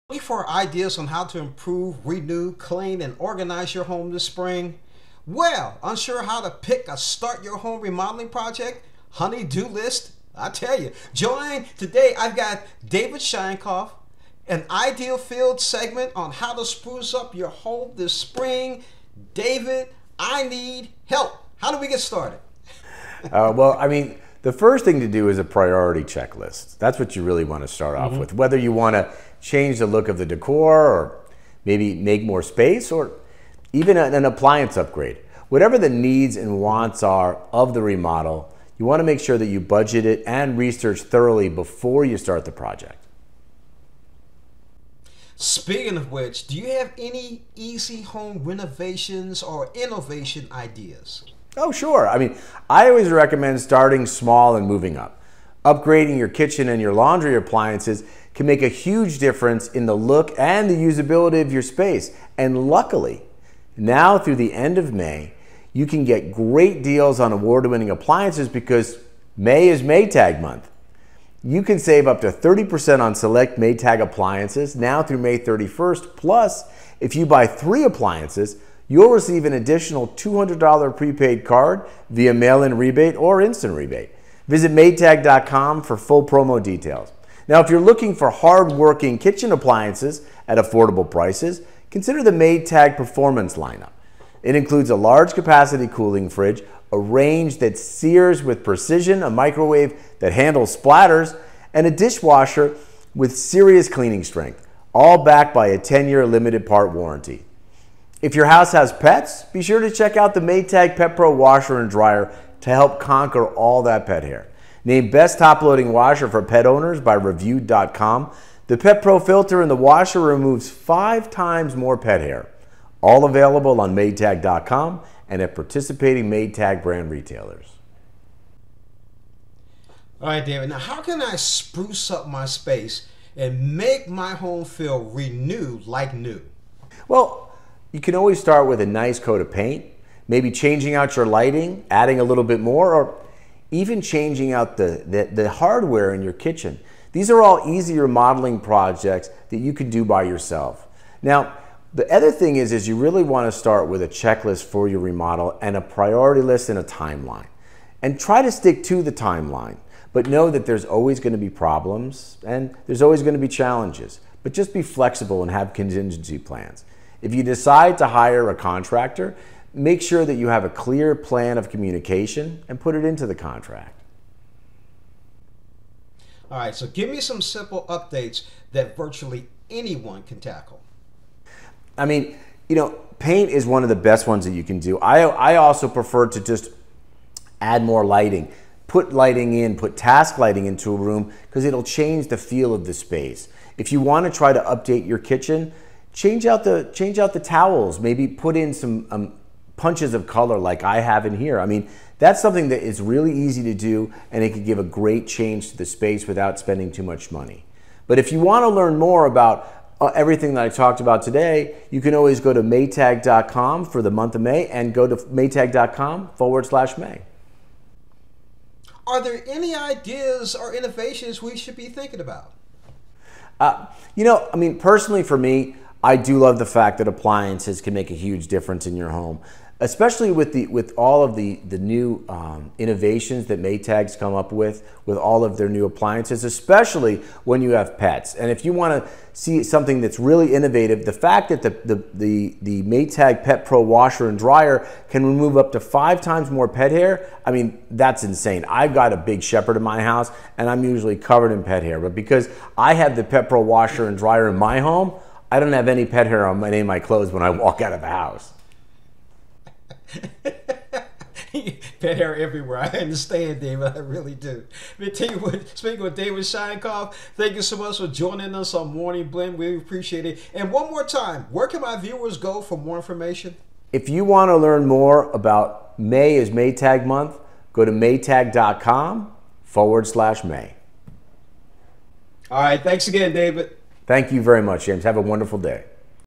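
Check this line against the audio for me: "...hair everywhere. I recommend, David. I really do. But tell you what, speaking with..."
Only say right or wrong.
wrong.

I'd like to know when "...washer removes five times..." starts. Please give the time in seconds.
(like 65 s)
119 s.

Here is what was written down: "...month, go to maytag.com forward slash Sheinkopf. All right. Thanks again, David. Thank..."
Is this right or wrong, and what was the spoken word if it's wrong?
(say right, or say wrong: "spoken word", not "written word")
wrong: "May", not "Sheinkopf".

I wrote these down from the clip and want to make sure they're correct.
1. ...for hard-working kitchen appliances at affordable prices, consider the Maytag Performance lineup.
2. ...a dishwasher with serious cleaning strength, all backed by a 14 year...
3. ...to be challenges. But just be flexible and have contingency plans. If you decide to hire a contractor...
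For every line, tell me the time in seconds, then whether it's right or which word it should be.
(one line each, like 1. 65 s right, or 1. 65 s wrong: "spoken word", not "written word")
1. 88 s right
2. 101 s wrong: "10", not "14"
3. 163 s right.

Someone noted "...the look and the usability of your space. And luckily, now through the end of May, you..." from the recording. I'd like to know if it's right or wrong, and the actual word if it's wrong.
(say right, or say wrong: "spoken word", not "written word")
right.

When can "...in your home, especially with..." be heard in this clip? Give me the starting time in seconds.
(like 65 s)
228 s.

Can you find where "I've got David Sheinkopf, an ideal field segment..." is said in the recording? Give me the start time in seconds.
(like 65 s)
12 s.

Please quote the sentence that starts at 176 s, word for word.
All right, so give me some simple updates that virtually anyone can tackle.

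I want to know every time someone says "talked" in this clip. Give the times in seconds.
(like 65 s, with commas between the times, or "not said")
210 s.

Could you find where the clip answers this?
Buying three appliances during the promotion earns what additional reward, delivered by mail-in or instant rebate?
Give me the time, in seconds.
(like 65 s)
80 s.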